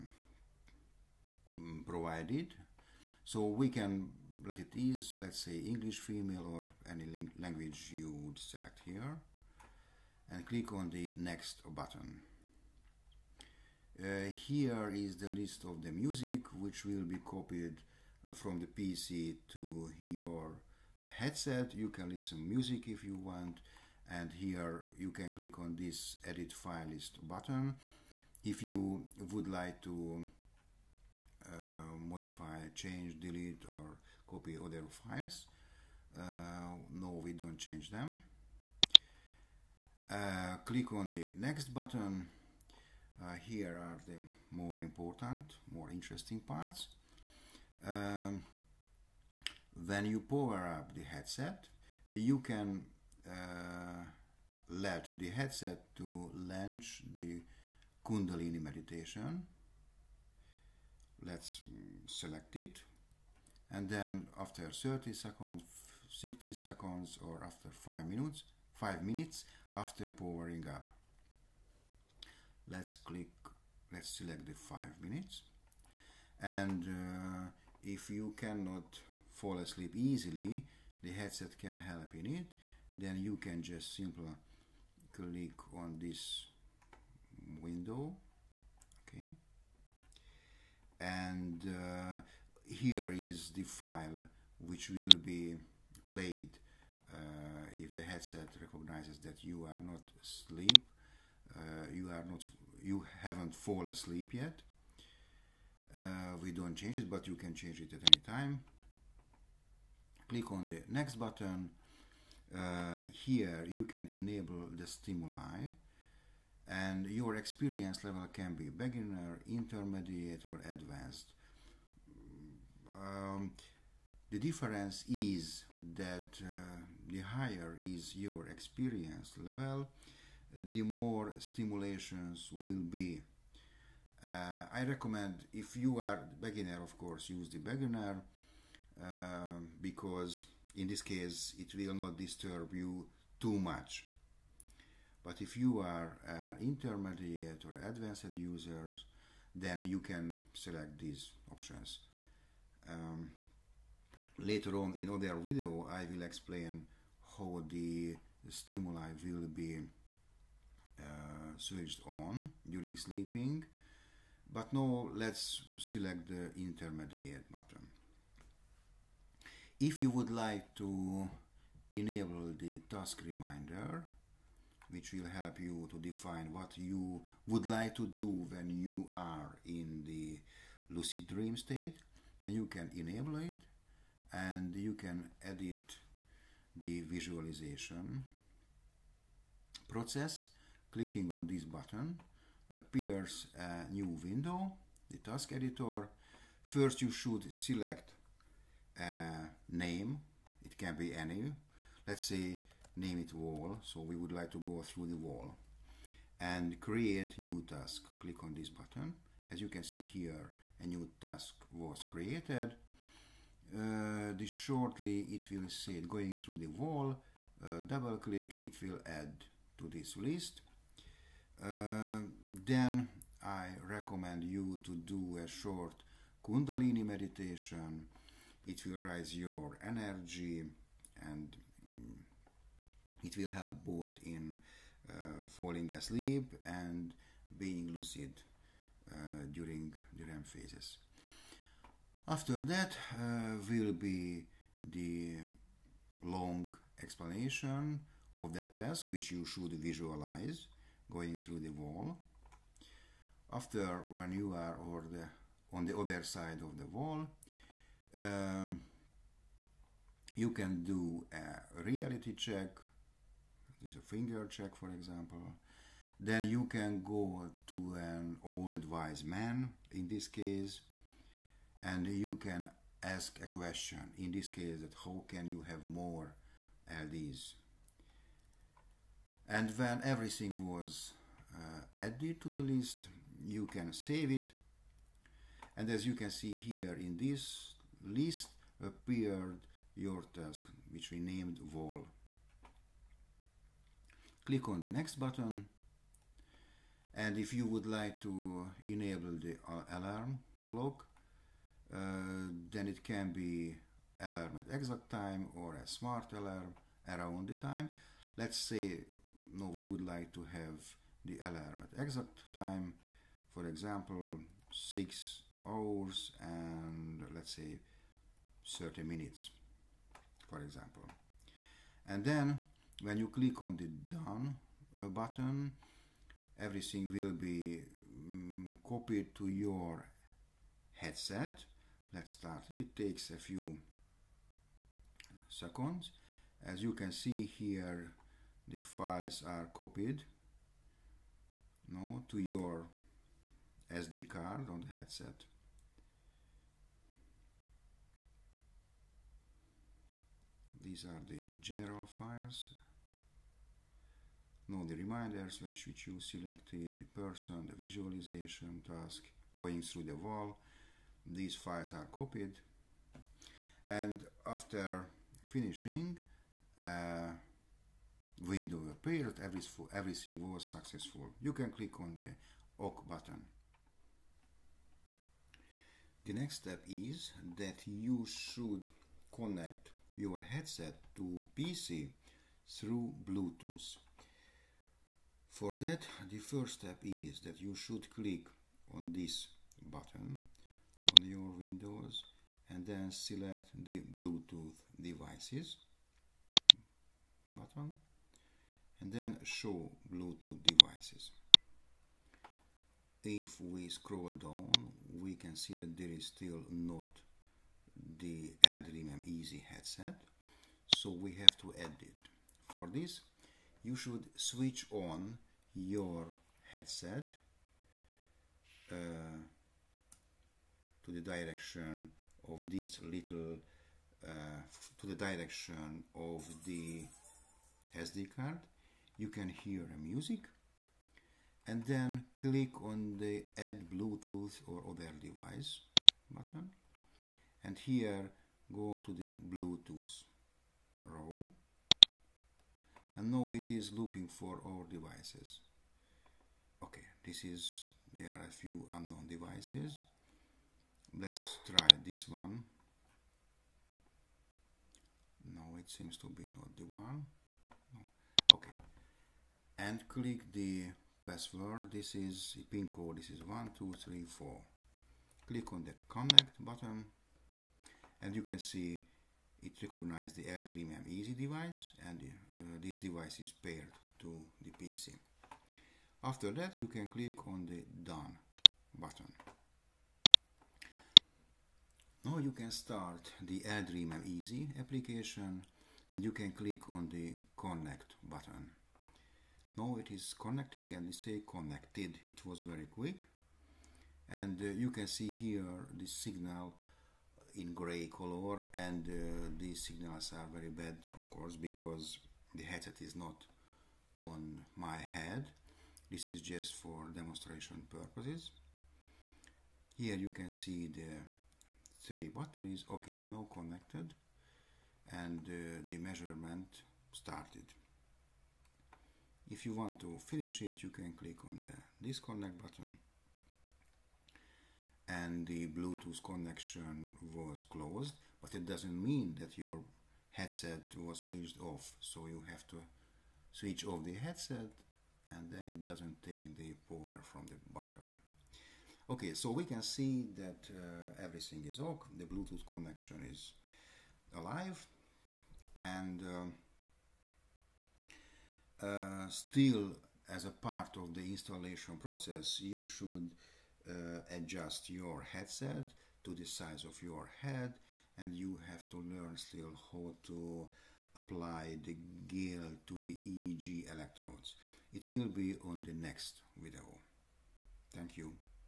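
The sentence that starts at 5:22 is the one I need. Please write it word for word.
And then when you click on the done uh, button, everything will be um, copied to your headset.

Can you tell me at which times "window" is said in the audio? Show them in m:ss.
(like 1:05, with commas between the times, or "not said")
1:27, 3:14, 6:08, 6:31.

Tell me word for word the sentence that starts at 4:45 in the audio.
And as you can see here in this list appeared your task, which we named wall.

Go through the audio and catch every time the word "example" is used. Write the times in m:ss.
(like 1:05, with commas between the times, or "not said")
4:24, 5:13, 5:20.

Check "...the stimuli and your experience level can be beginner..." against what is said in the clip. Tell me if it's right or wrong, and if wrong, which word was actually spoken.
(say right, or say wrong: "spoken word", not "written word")
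right.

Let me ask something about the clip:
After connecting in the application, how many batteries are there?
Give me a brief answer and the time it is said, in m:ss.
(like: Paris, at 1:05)
3, at 8:32.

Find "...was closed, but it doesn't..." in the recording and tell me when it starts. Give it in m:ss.
8:47.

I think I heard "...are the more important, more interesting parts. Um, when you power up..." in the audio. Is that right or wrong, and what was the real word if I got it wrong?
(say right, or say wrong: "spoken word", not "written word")
right.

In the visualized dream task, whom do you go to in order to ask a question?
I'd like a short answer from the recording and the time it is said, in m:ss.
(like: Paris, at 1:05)
an old wise man, at 4:28.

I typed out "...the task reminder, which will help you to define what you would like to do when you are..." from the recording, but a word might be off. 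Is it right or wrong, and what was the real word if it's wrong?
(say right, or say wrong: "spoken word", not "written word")
right.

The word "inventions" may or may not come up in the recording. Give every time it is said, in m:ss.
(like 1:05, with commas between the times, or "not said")
not said.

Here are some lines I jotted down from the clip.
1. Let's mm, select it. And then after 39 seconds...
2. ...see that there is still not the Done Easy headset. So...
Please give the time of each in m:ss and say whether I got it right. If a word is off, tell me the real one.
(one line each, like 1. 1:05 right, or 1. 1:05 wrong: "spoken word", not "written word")
1. 1:01 wrong: "30", not "39"
2. 6:45 wrong: "LdreamM", not "Done".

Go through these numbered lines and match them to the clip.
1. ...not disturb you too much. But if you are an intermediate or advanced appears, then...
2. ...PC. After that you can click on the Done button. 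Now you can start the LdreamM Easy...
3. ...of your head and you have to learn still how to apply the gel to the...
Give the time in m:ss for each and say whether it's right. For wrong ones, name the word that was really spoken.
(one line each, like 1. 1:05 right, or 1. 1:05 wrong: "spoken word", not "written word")
1. 2:21 wrong: "users", not "appears"
2. 7:54 right
3. 9:16 right.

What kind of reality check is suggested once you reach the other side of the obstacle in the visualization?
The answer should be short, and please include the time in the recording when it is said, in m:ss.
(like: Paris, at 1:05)
finger check, at 4:23.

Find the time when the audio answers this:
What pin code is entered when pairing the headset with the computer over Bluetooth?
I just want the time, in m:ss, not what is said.
7:43.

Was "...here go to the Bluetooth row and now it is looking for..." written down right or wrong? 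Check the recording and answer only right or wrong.
right.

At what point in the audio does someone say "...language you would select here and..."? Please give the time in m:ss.
0:07.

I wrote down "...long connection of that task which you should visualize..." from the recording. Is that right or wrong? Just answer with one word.
wrong.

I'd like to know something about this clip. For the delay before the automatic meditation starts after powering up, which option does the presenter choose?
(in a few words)
5 minutes.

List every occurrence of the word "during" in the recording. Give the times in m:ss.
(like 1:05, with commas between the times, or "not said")
2:42, 3:59.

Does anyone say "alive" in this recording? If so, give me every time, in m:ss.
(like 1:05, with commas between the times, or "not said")
9:04.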